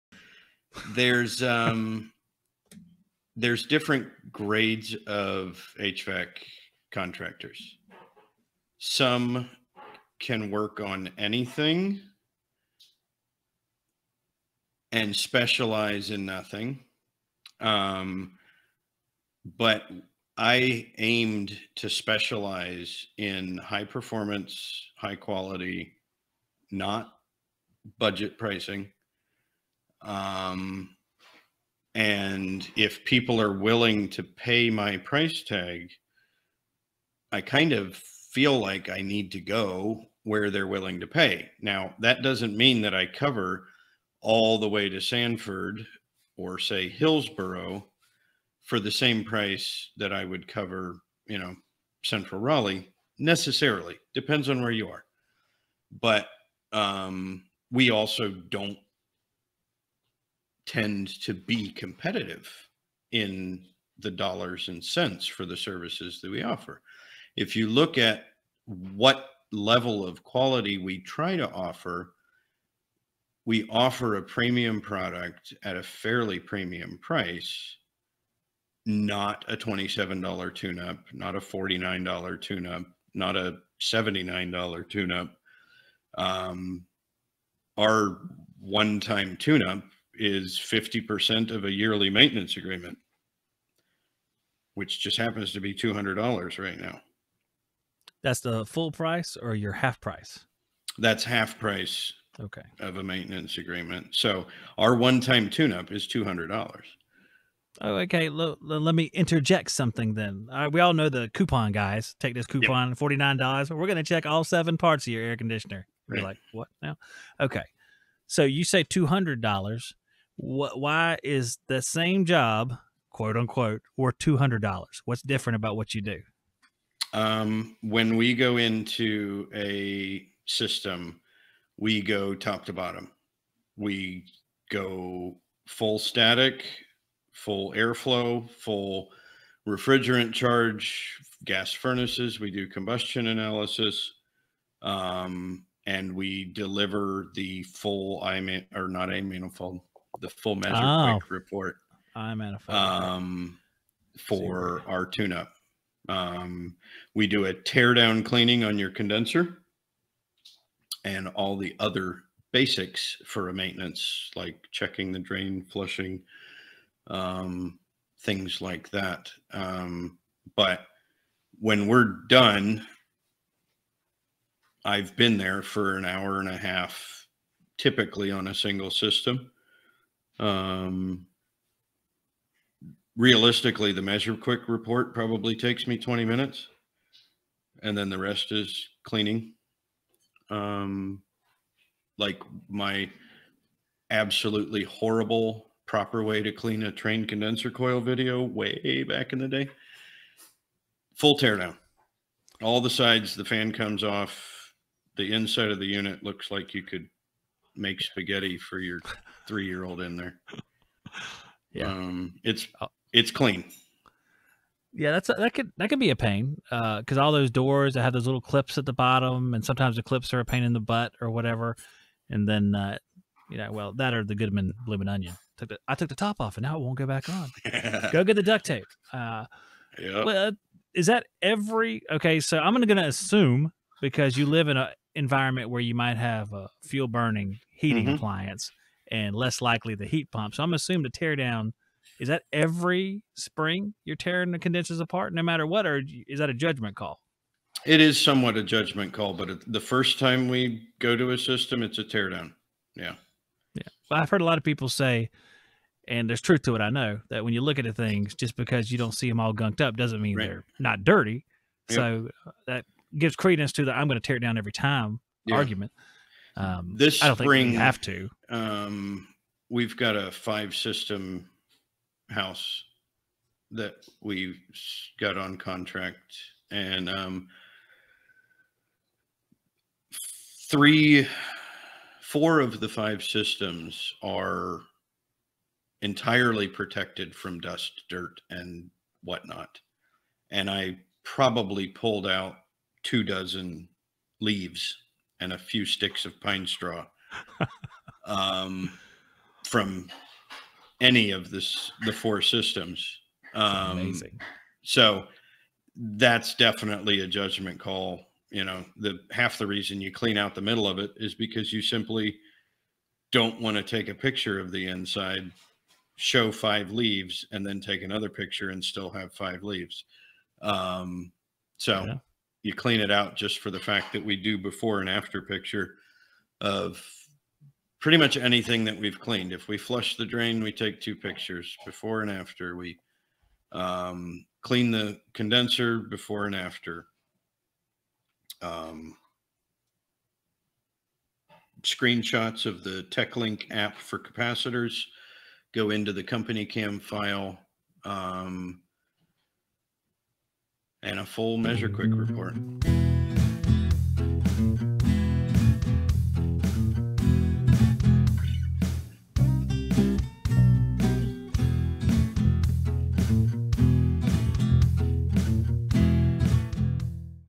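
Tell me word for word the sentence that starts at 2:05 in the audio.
What's different about what you do?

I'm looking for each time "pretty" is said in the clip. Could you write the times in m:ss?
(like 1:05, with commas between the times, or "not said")
5:27.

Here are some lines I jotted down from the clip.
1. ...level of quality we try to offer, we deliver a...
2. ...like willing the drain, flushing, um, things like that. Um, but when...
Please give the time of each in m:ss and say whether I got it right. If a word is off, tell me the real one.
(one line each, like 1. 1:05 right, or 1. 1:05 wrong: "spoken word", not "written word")
1. 1:09 wrong: "offer", not "deliver"
2. 2:44 wrong: "checking", not "willing".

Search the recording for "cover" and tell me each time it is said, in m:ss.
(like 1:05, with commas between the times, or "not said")
0:43, 0:50.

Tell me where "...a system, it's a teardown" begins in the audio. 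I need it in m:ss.
4:11.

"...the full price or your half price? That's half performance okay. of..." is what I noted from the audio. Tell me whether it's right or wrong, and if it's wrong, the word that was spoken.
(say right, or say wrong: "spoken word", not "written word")
wrong: "price", not "performance".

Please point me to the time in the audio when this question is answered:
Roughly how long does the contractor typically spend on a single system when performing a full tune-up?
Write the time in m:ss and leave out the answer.
2:55.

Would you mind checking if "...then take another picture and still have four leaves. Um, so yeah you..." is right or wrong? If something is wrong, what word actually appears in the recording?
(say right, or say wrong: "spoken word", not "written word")
wrong: "five", not "four".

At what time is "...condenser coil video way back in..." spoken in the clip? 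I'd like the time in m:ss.
3:17.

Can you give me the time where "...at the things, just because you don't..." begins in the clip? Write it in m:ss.
4:17.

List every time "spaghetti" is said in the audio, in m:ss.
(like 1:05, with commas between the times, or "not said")
3:28.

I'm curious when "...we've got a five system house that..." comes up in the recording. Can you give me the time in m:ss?
4:29.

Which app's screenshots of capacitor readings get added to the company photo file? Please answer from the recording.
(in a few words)
TechLink.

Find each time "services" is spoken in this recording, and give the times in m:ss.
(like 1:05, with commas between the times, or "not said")
1:05.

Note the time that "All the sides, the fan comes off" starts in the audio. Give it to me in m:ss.
3:22.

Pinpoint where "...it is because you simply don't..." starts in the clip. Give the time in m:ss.
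5:10.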